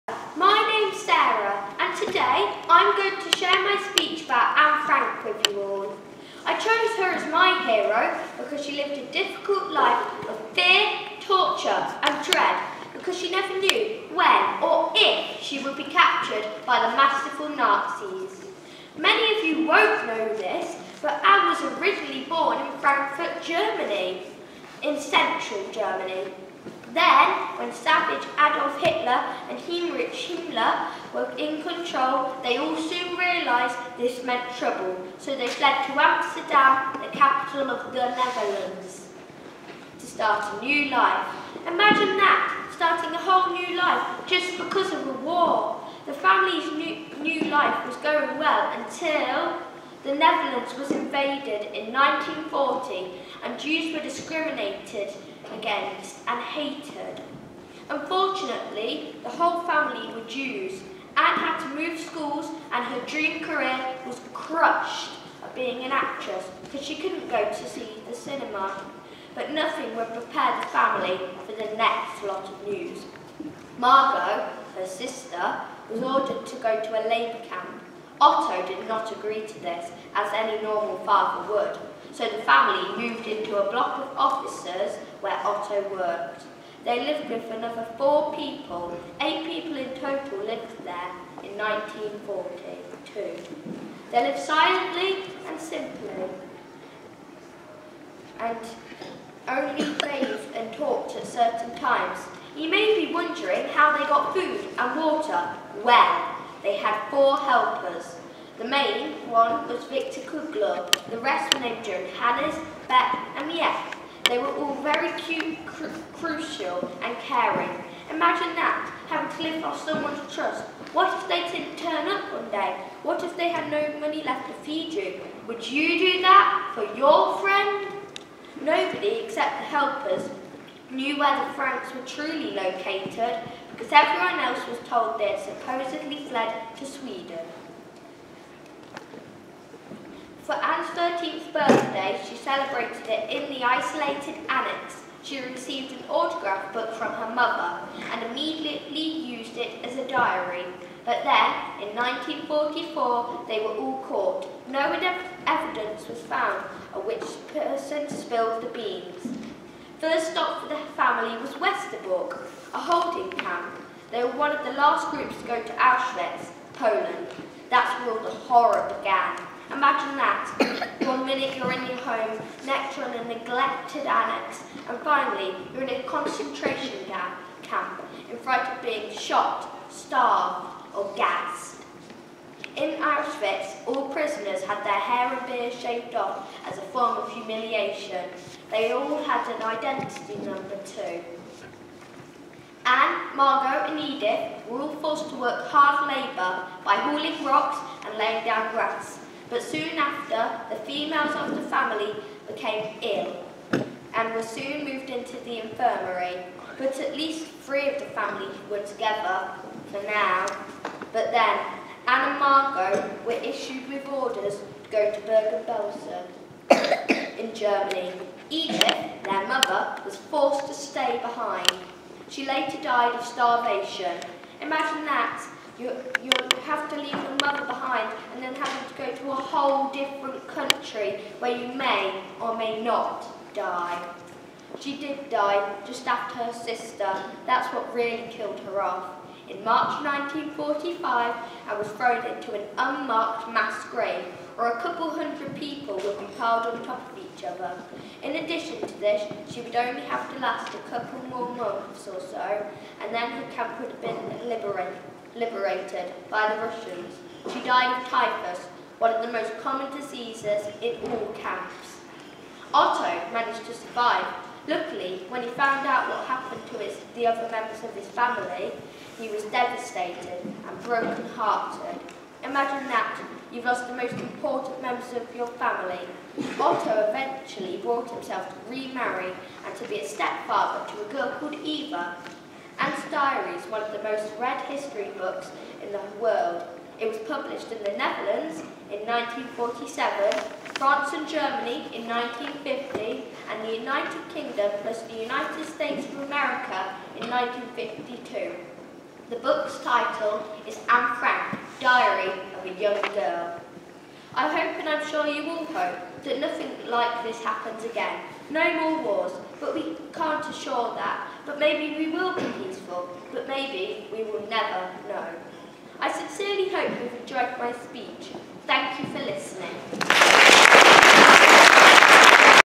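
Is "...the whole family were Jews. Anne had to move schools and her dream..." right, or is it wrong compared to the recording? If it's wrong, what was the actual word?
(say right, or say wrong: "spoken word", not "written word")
right.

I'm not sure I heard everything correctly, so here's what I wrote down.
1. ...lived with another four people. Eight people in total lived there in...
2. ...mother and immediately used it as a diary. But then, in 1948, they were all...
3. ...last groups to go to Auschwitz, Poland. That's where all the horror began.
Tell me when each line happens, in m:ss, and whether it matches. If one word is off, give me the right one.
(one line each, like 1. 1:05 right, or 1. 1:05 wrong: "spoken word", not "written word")
1. 1:27 right
2. 2:27 wrong: "1944", not "1948"
3. 2:44 right.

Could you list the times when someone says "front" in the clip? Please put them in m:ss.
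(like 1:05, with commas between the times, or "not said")
2:58.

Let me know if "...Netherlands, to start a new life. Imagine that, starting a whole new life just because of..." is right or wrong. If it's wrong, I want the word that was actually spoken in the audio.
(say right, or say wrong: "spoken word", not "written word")
right.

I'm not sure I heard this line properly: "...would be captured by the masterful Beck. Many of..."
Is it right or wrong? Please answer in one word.
wrong.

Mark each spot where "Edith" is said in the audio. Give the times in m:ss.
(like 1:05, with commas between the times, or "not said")
3:13, 3:38.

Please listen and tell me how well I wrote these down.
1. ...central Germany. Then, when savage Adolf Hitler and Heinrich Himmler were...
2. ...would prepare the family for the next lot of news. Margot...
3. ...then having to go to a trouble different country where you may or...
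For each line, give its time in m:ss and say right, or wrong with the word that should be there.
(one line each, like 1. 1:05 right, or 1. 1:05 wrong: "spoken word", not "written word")
1. 0:24 right
2. 1:09 right
3. 3:48 wrong: "whole", not "trouble".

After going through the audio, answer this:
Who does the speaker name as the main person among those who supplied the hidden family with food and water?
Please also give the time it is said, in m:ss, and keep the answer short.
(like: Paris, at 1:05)
Victor Kugler, at 1:49.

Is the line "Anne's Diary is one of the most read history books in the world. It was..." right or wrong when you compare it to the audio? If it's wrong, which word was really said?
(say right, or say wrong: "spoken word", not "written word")
right.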